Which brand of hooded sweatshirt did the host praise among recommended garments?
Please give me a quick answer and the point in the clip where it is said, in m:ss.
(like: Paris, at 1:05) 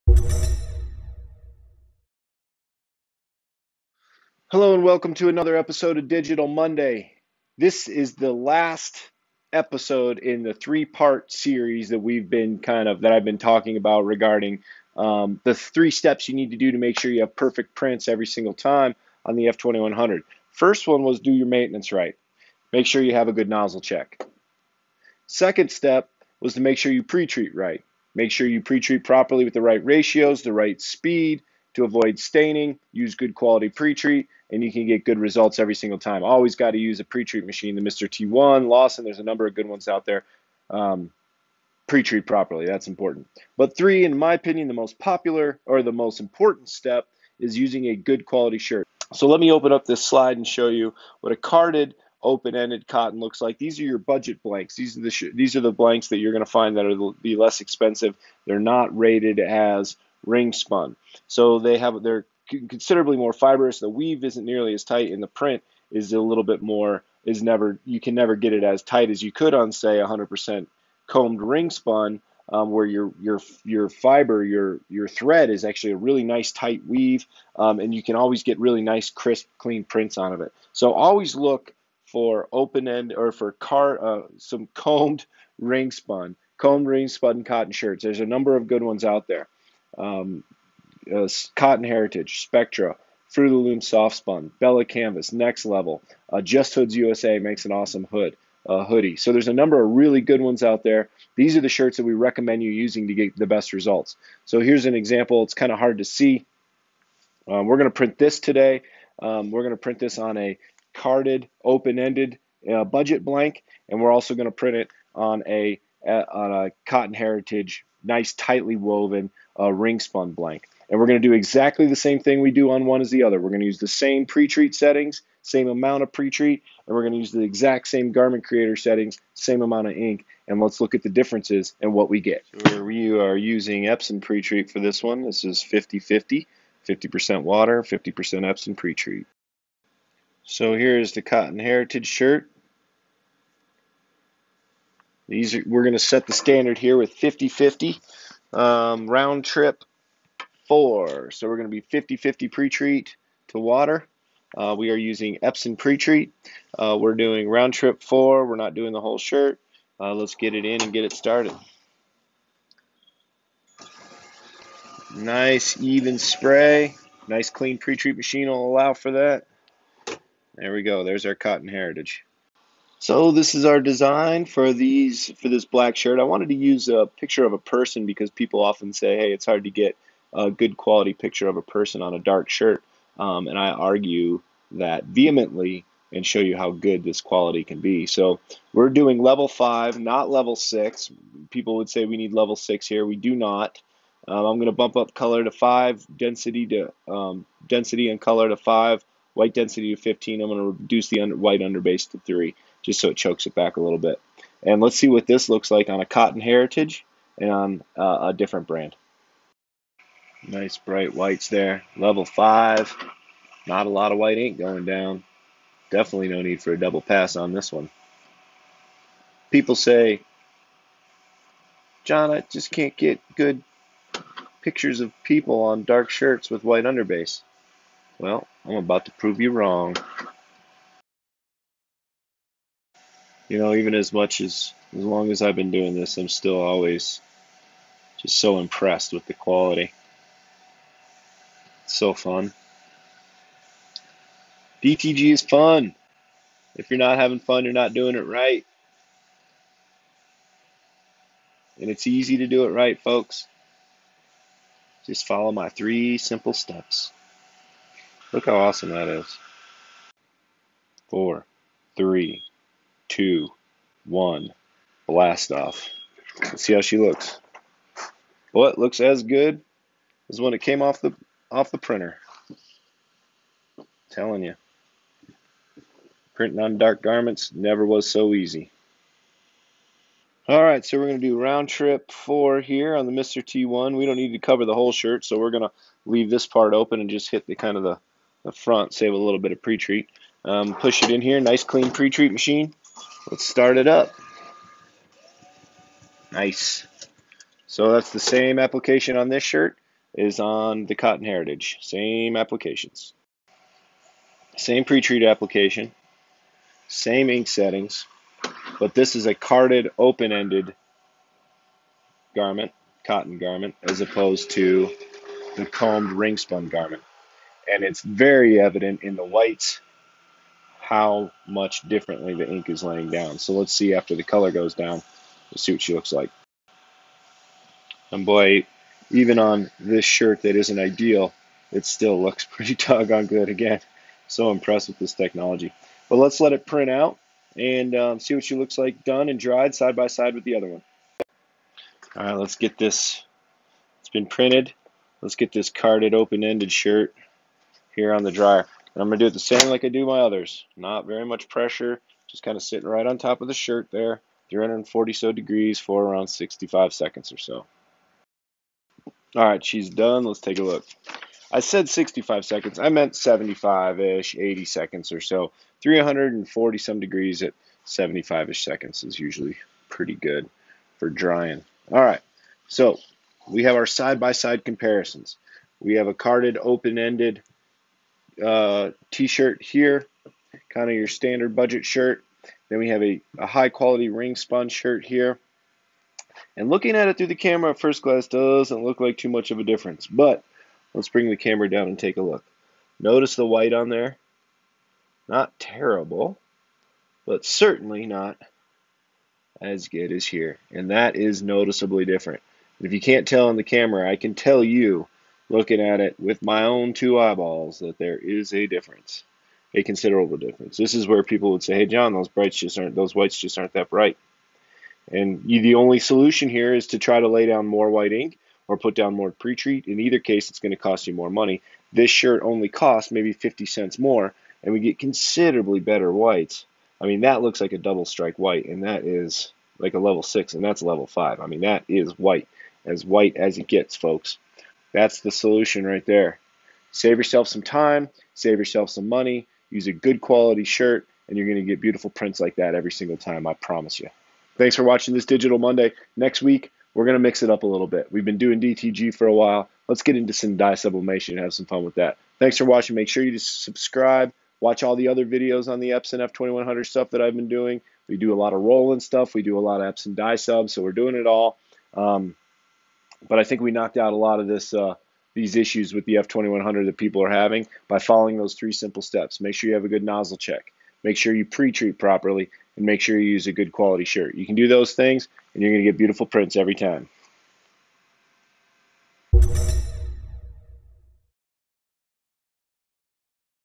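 Just Hoods USA, at 1:36.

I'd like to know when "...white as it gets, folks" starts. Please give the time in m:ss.
7:13.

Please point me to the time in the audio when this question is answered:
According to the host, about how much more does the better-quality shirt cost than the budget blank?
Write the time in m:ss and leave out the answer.
7:03.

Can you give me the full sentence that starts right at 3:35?
Definitely no need for a double pass on this one.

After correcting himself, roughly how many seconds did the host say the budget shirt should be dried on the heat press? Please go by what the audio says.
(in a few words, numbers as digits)
75-80 seconds.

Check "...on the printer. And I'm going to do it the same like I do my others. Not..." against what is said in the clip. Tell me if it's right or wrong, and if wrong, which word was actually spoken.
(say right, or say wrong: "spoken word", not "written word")
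wrong: "dryer", not "printer".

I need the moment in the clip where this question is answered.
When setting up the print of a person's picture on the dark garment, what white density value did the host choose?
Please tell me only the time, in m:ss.
3:19.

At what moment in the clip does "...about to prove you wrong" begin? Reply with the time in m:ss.
3:48.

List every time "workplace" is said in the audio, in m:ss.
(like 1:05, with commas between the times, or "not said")
not said.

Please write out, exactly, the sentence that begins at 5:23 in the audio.
So let's see after the color goes down, let's see what she looks like.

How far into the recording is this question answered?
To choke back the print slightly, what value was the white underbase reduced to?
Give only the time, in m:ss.
3:21.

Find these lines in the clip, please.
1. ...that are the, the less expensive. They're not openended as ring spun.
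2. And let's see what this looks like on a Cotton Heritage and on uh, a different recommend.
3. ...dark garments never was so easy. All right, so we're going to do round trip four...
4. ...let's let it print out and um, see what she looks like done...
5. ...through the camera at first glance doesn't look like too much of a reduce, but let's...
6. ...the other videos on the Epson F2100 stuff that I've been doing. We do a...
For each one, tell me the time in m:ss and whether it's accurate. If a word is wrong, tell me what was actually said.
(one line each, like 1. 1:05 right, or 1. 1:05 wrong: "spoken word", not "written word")
1. 0:56 wrong: "rated", not "openended"
2. 3:24 wrong: "brand", not "recommend"
3. 4:36 right
4. 5:36 right
5. 6:27 wrong: "difference", not "reduce"
6. 7:34 right.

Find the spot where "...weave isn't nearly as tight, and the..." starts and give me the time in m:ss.
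1:03.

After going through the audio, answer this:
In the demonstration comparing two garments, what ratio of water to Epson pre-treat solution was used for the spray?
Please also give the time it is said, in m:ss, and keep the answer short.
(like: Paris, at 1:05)
50-50, at 2:15.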